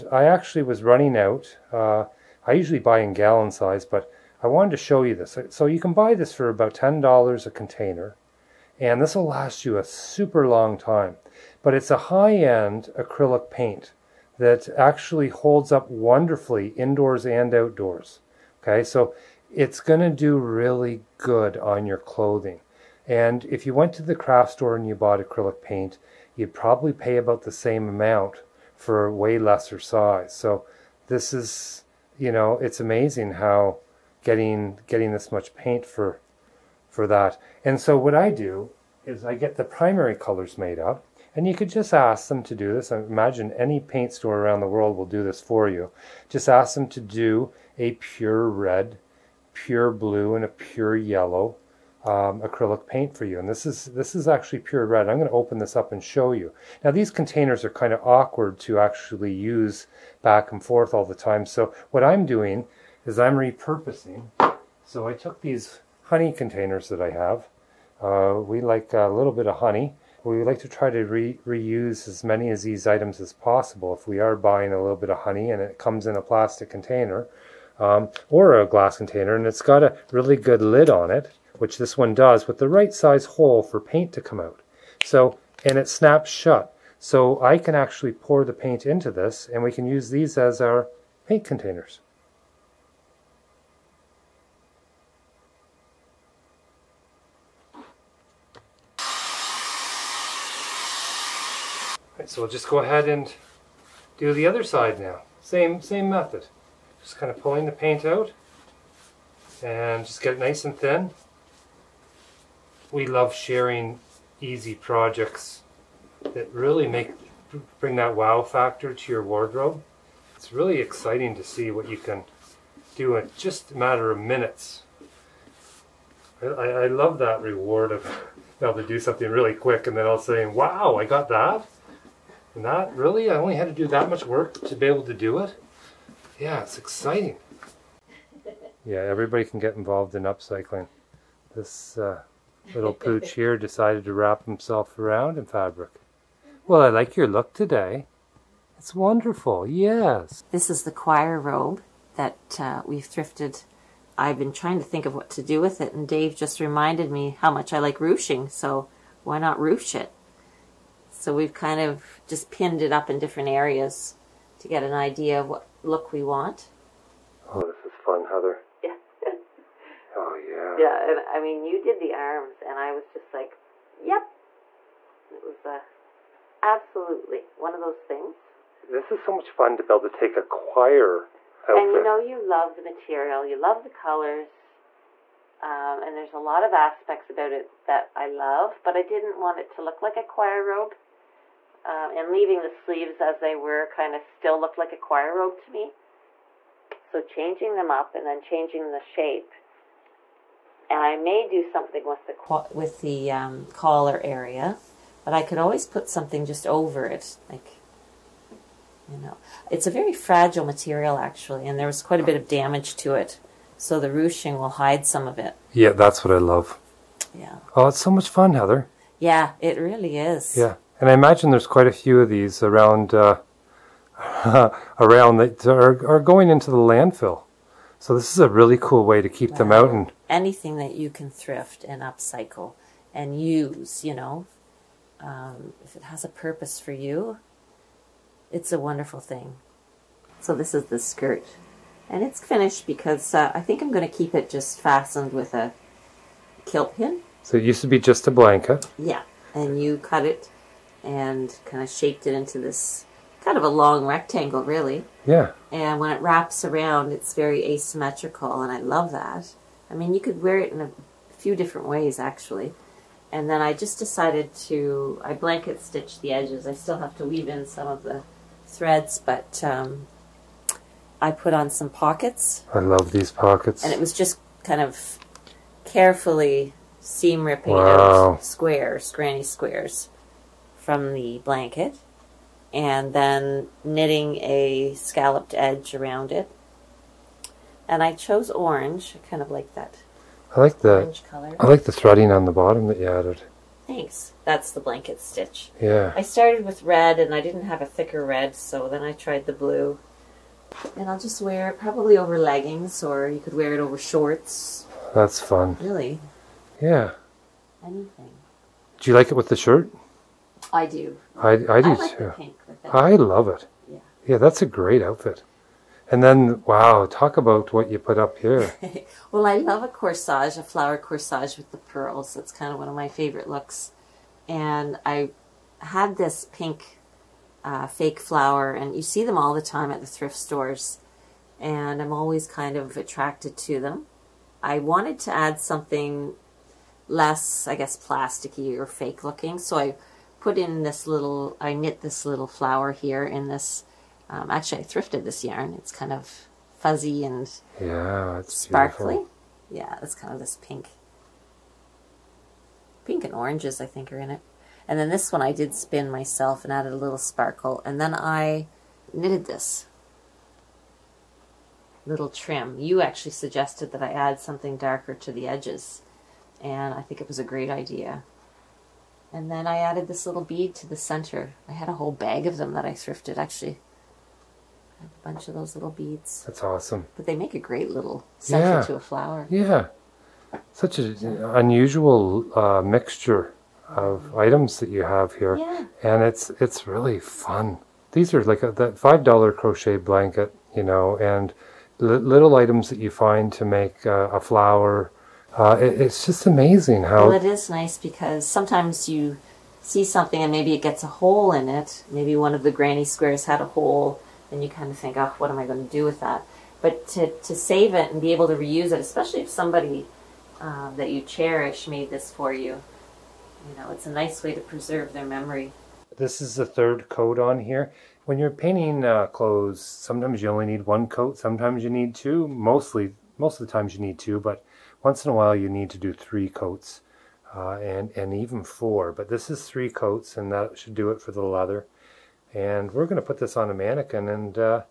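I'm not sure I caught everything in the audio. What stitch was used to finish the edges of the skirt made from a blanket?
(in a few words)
Blanket stitch.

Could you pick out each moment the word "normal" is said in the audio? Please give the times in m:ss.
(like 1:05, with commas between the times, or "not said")
not said.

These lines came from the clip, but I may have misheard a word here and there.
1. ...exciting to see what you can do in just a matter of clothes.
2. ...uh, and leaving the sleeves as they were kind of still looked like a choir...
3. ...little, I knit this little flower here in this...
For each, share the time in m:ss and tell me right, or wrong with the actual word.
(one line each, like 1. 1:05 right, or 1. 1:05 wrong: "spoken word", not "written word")
1. 2:00 wrong: "minutes", not "clothes"
2. 3:11 right
3. 5:41 right.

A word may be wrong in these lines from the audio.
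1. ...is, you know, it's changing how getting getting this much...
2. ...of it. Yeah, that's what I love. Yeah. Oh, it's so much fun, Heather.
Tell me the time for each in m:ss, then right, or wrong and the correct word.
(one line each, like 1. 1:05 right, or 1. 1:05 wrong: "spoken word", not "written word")
1. 0:31 wrong: "amazing", not "changing"
2. 3:35 right.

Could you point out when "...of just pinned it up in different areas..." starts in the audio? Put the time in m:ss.
2:41.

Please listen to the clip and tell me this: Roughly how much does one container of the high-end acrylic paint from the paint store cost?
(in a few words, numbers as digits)
$10.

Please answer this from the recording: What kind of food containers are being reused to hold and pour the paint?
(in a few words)
Honey containers.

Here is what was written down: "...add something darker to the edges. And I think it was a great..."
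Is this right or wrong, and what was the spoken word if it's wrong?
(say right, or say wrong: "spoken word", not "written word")
right.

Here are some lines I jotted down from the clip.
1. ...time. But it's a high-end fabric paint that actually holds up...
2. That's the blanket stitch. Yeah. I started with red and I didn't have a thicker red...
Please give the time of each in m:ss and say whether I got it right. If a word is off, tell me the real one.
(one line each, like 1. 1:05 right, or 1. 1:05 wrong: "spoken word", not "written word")
1. 0:10 wrong: "acrylic", not "fabric"
2. 4:54 right.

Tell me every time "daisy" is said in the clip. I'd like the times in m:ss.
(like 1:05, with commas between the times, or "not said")
not said.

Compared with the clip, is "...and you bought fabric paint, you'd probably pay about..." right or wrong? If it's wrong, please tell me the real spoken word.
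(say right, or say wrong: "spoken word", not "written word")
wrong: "acrylic", not "fabric".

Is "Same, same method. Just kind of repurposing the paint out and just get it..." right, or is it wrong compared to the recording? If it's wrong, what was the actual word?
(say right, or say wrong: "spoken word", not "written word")
wrong: "pulling", not "repurposing".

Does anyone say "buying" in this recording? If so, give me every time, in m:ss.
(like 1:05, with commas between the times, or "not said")
1:14.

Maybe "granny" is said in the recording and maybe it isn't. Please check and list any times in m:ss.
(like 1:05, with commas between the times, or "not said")
4:39, 6:42.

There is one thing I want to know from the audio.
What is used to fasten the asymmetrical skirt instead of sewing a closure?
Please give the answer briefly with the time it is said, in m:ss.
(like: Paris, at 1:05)
Kilt pin, at 4:06.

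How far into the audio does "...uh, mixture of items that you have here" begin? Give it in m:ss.
6:22.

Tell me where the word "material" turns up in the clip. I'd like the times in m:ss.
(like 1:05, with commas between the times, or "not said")
3:02, 3:30.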